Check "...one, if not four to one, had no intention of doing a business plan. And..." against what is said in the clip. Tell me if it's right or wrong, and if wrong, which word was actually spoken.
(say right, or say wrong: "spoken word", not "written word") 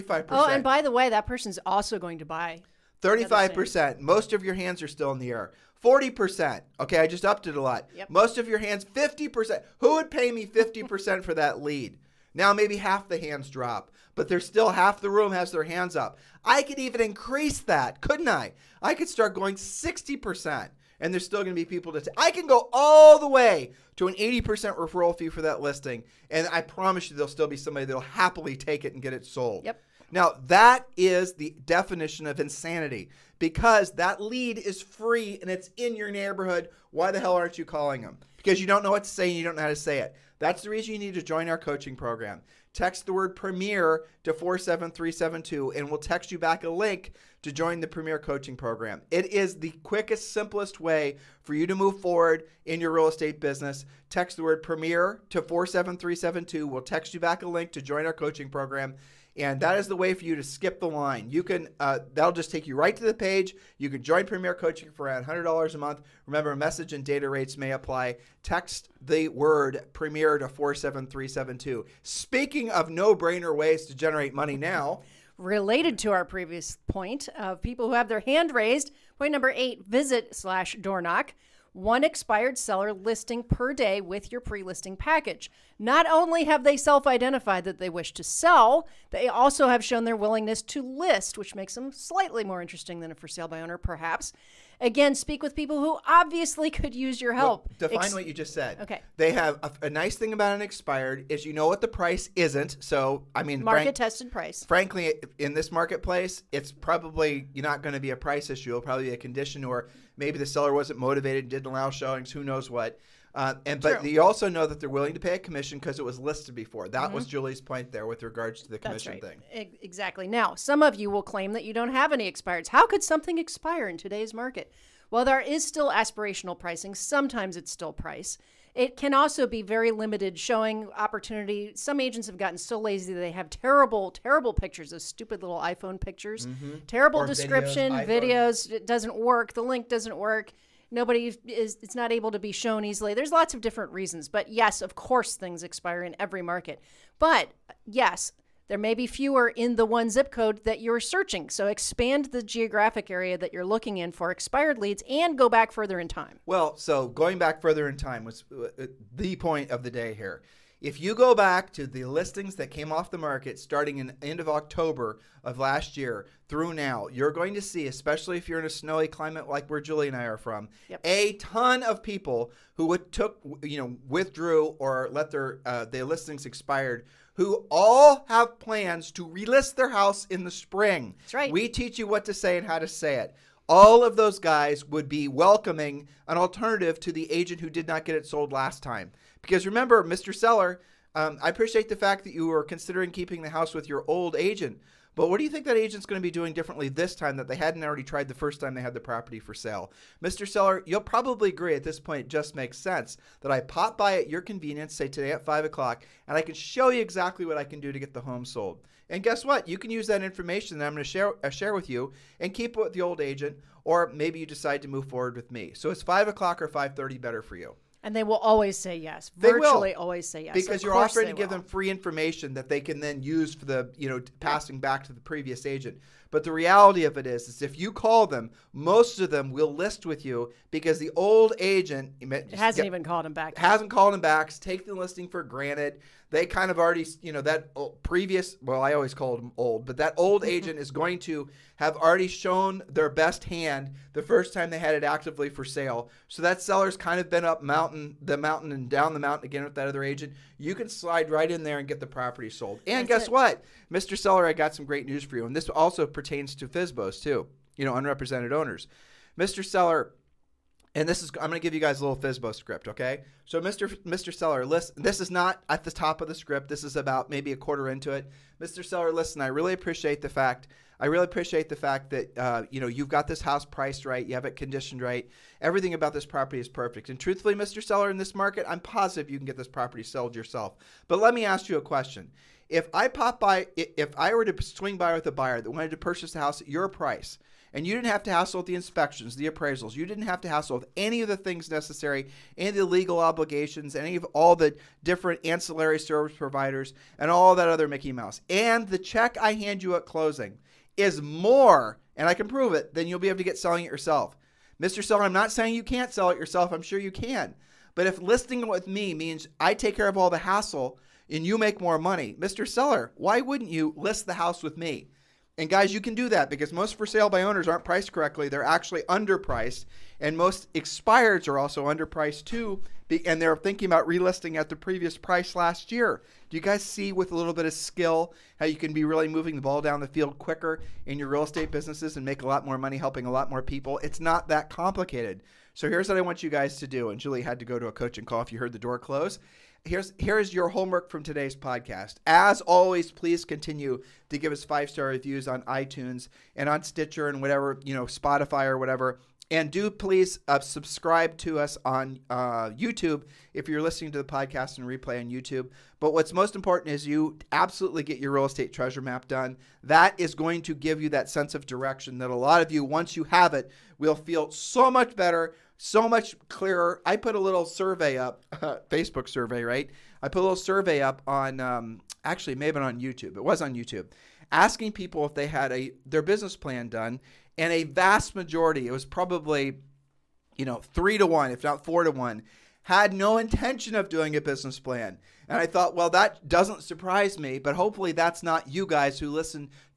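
right.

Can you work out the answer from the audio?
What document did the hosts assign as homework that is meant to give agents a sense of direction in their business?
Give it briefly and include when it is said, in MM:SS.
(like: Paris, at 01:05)
real estate treasure map, at 05:58.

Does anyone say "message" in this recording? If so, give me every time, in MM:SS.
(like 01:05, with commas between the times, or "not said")
01:06.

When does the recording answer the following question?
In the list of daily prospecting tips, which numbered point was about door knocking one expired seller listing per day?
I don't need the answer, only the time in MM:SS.
01:19.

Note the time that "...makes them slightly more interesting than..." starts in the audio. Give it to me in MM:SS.
01:31.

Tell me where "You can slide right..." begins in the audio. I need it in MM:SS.
04:10.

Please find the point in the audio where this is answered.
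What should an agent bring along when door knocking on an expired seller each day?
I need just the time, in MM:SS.
01:24.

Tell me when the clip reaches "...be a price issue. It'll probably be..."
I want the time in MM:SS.
01:48.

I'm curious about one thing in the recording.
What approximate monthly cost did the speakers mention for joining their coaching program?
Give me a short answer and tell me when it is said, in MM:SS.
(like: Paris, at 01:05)
$100, at 01:05.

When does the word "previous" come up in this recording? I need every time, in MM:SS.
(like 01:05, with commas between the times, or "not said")
01:16, 03:45, 03:58, 05:24.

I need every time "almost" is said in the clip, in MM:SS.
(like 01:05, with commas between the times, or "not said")
not said.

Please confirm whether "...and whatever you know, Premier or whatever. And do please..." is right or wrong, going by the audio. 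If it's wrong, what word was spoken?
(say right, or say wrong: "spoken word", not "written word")
wrong: "Spotify", not "Premier".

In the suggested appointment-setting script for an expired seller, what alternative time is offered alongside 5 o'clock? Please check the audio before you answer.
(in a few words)
5:30.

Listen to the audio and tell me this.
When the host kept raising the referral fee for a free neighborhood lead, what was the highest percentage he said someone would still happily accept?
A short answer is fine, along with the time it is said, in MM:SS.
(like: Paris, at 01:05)
80%, at 00:24.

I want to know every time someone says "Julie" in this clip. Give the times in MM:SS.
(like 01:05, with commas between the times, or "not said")
01:57, 02:49, 05:37.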